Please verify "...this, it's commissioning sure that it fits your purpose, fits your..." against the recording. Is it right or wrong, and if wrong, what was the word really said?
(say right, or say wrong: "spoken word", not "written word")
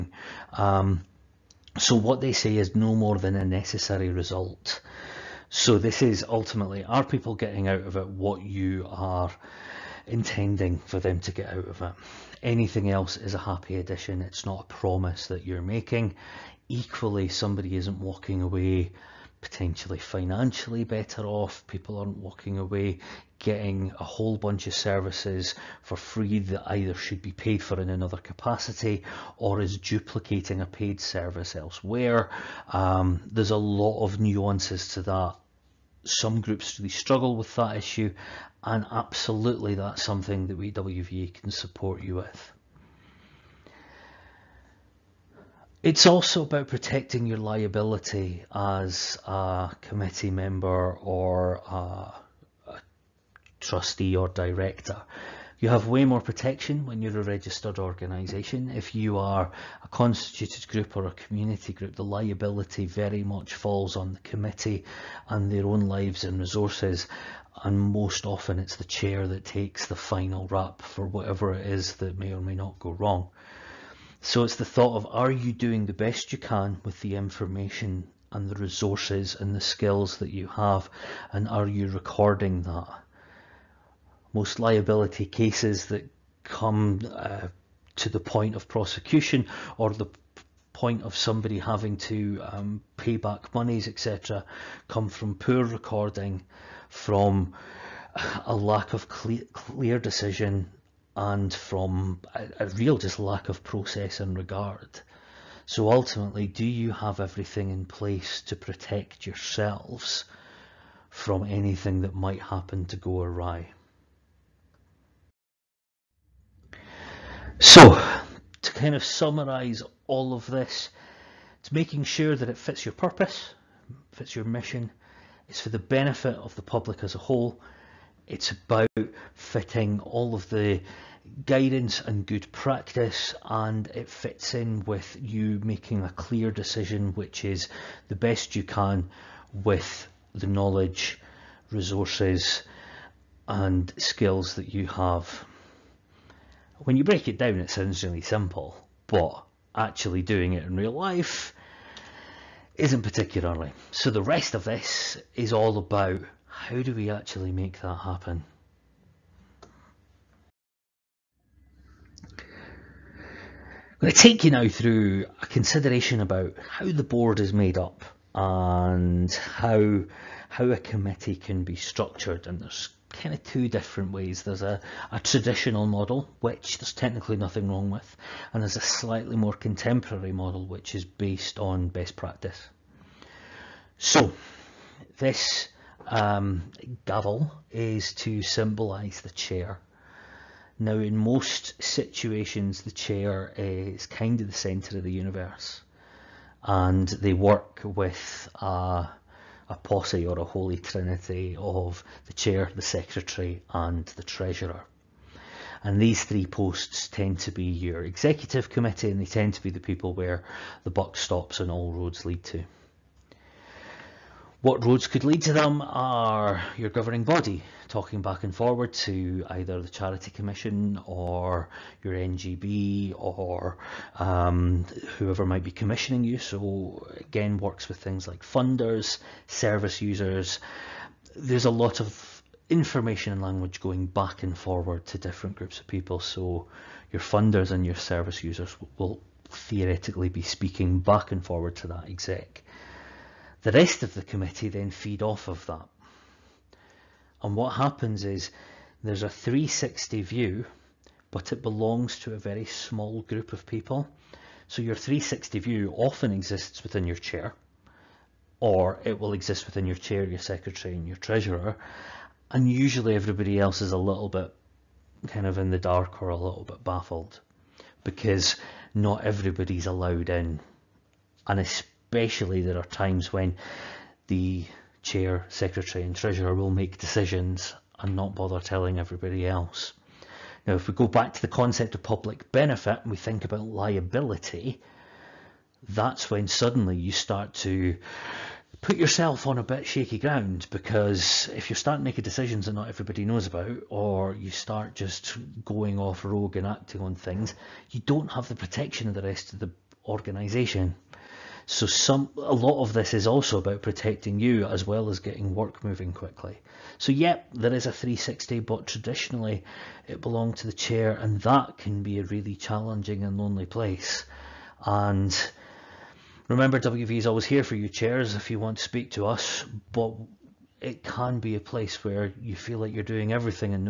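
wrong: "making", not "commissioning".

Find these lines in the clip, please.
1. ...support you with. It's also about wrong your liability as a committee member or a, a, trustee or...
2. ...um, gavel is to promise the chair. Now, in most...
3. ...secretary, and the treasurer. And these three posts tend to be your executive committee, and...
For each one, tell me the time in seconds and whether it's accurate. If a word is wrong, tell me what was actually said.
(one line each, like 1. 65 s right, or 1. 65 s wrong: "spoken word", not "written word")
1. 41 s wrong: "protecting", not "wrong"
2. 186 s wrong: "symbolise", not "promise"
3. 202 s right.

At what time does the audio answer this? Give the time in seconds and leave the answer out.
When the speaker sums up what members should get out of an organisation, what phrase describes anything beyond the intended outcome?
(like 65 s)
13 s.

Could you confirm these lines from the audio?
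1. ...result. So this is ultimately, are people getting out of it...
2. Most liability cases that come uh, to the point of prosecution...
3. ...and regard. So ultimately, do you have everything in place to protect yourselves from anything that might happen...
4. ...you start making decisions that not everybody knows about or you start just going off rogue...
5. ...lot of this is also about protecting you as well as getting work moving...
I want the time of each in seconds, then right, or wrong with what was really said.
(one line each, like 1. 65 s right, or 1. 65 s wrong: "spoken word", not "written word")
1. 4 s right
2. 84 s right
3. 104 s right
4. 291 s right
5. 302 s right.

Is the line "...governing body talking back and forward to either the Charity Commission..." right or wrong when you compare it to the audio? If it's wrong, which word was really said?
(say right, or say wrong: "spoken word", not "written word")
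right.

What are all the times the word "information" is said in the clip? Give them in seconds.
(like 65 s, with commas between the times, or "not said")
77 s, 232 s.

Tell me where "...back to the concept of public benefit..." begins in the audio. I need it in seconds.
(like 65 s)
281 s.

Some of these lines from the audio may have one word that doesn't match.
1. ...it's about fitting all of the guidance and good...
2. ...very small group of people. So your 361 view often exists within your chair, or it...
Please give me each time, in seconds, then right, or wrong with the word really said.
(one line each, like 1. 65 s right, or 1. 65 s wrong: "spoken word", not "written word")
1. 128 s right
2. 252 s wrong: "360", not "361".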